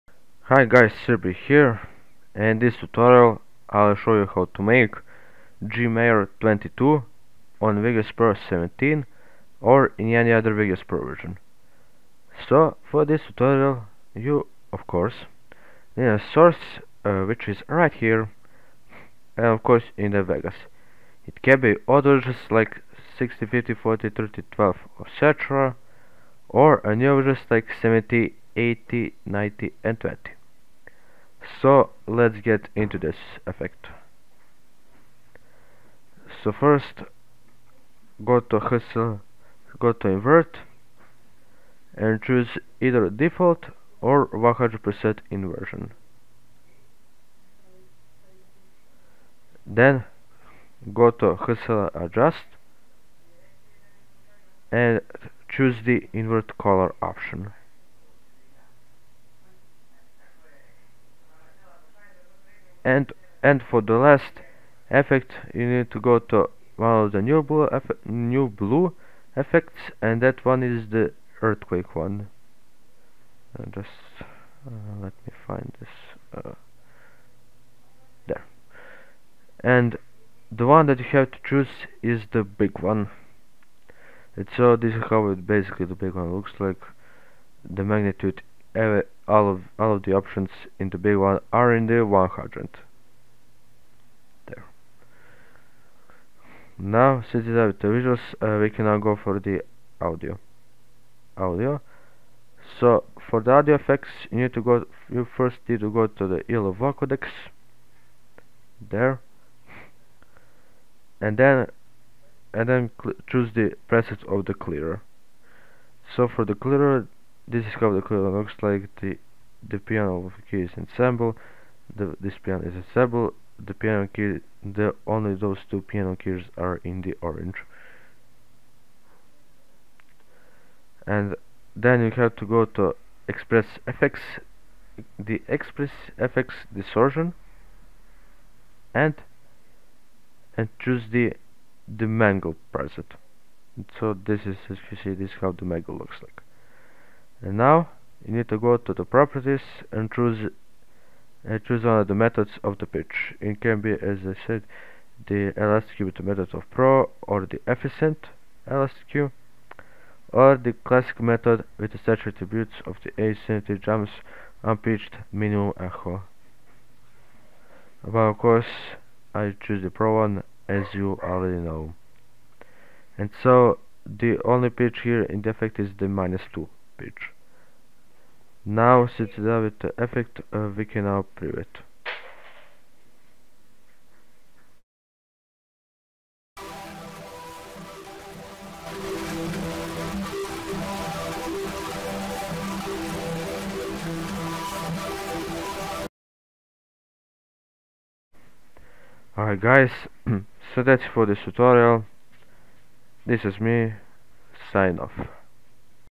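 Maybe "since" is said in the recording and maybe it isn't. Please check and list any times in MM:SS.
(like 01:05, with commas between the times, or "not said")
01:37, 02:59.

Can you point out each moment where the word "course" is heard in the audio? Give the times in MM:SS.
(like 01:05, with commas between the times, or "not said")
00:14, 00:19, 02:48.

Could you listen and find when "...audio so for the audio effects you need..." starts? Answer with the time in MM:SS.
01:41.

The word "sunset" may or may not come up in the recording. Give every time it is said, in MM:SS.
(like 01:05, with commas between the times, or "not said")
not said.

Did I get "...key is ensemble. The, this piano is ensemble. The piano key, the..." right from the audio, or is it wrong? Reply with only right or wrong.
right.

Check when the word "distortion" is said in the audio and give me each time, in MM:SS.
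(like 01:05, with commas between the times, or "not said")
02:16.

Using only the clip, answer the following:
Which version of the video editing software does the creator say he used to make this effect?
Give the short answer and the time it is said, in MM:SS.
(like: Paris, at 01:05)
17, at 00:07.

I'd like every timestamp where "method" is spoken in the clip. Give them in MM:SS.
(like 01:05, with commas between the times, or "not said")
02:32, 02:36, 02:41.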